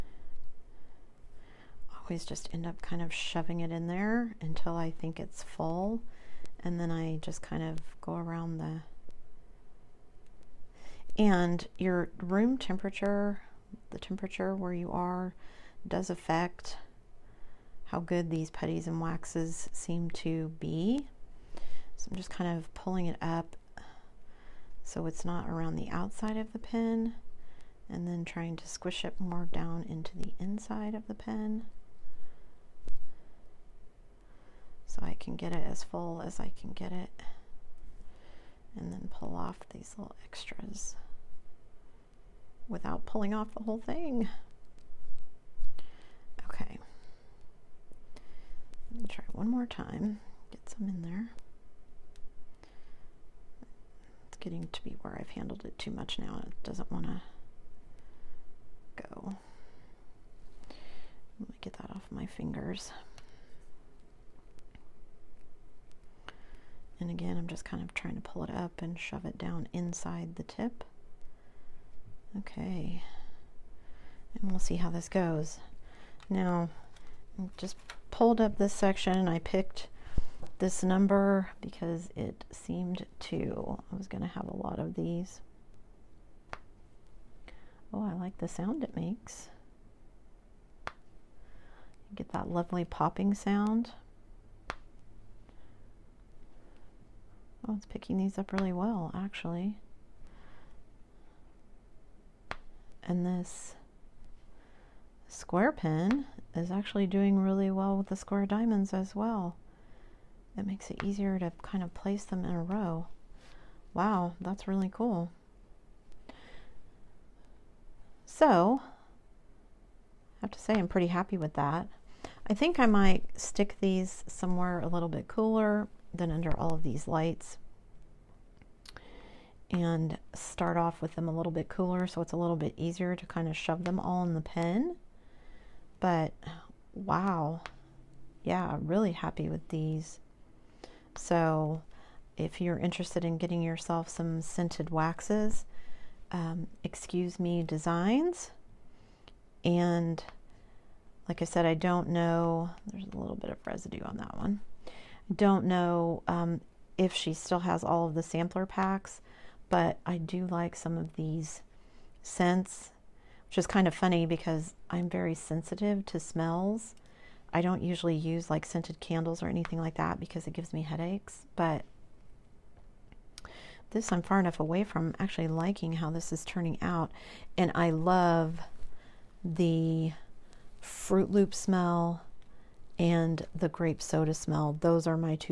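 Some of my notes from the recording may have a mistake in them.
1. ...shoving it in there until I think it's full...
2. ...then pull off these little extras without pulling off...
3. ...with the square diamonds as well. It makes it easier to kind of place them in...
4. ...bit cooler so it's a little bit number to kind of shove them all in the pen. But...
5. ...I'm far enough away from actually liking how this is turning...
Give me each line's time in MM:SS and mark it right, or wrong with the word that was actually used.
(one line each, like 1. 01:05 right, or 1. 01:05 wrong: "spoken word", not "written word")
1. 00:03 right
2. 00:38 right
3. 01:47 right
4. 02:11 wrong: "easier", not "number"
5. 02:54 right.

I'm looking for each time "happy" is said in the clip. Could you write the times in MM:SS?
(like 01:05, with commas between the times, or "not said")
02:01, 02:19.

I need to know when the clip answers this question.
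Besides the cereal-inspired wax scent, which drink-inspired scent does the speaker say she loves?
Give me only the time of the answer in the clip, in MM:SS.
03:03.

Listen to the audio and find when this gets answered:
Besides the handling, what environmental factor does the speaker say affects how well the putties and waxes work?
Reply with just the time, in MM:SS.
00:12.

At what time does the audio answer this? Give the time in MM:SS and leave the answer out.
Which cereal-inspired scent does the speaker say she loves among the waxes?
03:00.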